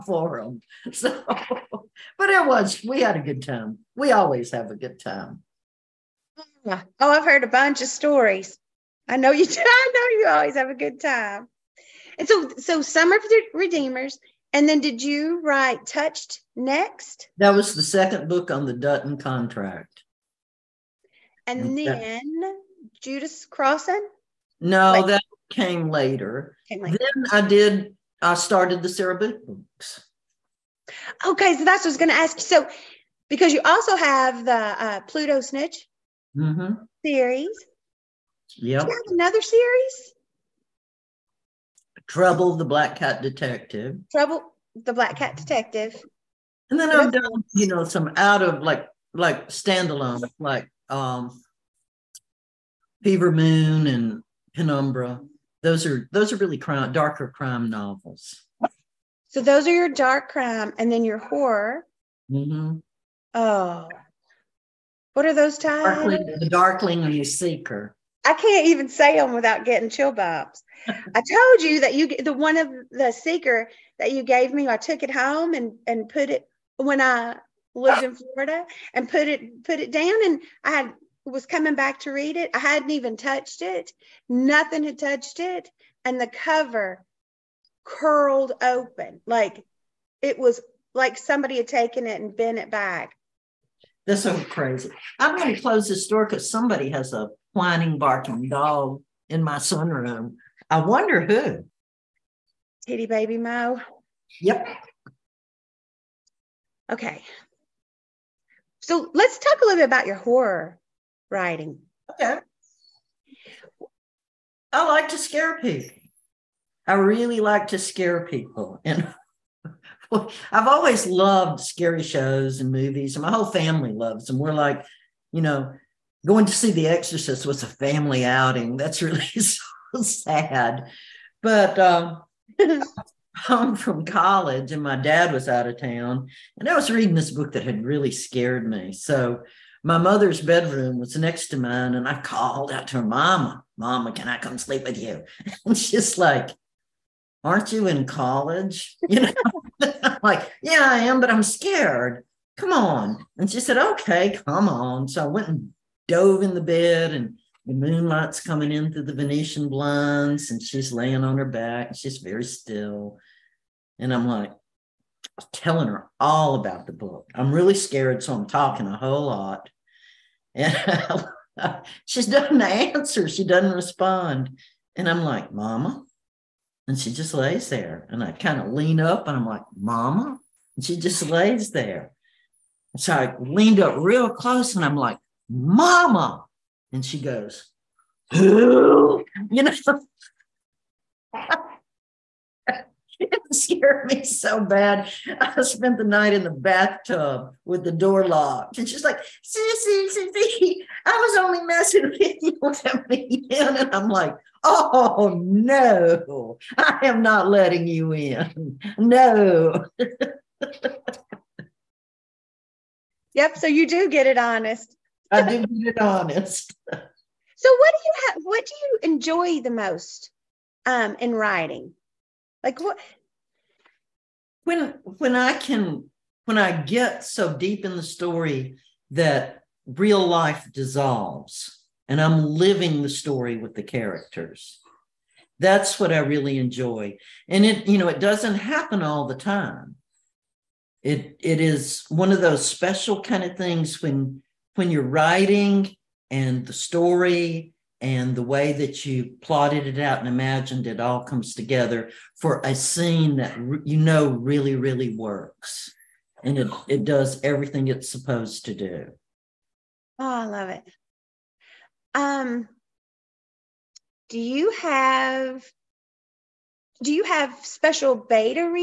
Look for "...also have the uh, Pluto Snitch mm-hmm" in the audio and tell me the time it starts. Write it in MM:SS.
00:33.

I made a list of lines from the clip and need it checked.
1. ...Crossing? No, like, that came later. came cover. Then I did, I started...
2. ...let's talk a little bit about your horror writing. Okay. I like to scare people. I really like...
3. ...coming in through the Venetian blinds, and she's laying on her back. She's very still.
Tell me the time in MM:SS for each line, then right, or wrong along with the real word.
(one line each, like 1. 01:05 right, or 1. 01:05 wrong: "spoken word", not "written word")
1. 00:23 wrong: "later", not "cover"
2. 01:49 right
3. 02:38 right.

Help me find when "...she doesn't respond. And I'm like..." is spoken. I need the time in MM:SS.
02:53.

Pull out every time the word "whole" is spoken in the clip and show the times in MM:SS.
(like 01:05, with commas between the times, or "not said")
02:03, 02:48.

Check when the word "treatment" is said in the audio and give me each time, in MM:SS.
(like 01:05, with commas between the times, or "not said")
not said.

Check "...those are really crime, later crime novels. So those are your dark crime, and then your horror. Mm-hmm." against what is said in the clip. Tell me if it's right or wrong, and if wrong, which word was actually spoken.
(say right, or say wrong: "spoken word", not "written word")
wrong: "darker", not "later".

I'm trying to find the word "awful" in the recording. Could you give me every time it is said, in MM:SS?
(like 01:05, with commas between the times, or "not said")
not said.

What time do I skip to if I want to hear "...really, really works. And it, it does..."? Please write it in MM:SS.
04:14.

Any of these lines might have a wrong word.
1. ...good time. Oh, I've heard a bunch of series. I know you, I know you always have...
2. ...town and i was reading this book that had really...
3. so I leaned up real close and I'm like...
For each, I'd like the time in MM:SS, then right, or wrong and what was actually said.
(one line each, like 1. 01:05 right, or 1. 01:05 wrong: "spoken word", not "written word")
1. 00:04 wrong: "stories", not "series"
2. 02:15 right
3. 03:02 right.